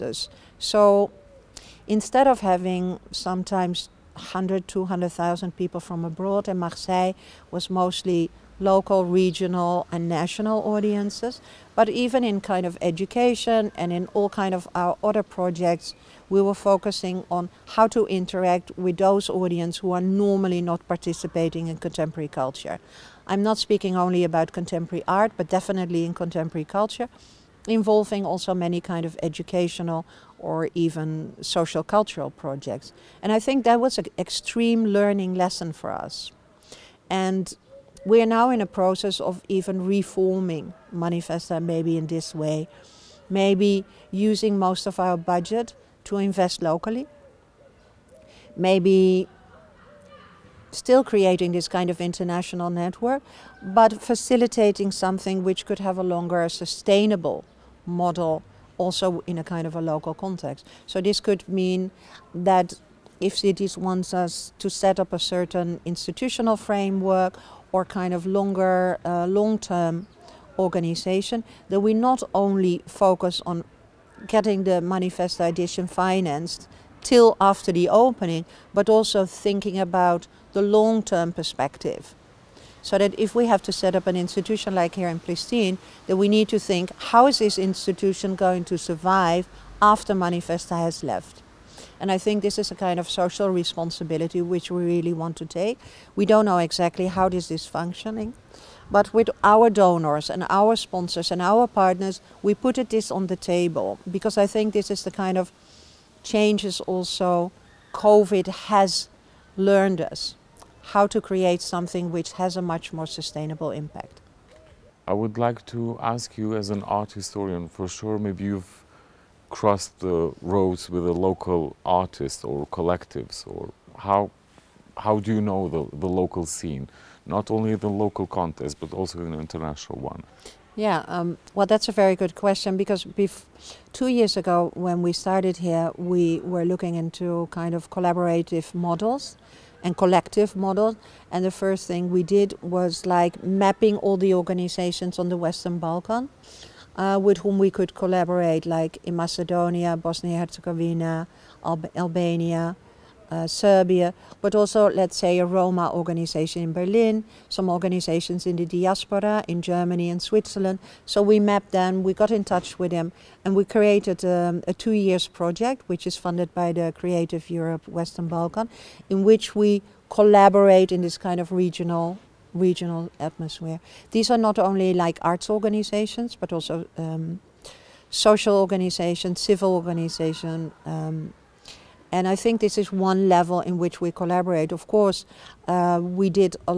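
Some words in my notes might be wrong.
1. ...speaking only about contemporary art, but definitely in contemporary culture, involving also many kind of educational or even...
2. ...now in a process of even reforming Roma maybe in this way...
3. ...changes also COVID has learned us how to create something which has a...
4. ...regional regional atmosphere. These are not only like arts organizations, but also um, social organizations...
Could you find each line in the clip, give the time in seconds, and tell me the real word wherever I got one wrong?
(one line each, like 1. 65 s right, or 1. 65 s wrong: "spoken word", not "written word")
1. 23 s right
2. 38 s wrong: "Manifesta", not "Roma"
3. 106 s right
4. 171 s right.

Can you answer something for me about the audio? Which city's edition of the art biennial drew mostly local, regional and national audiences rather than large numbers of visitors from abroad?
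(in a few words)
Marseille.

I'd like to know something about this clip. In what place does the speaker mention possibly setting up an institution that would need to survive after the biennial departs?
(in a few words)
Palestine.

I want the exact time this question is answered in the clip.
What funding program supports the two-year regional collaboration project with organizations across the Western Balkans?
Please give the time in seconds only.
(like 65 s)
166 s.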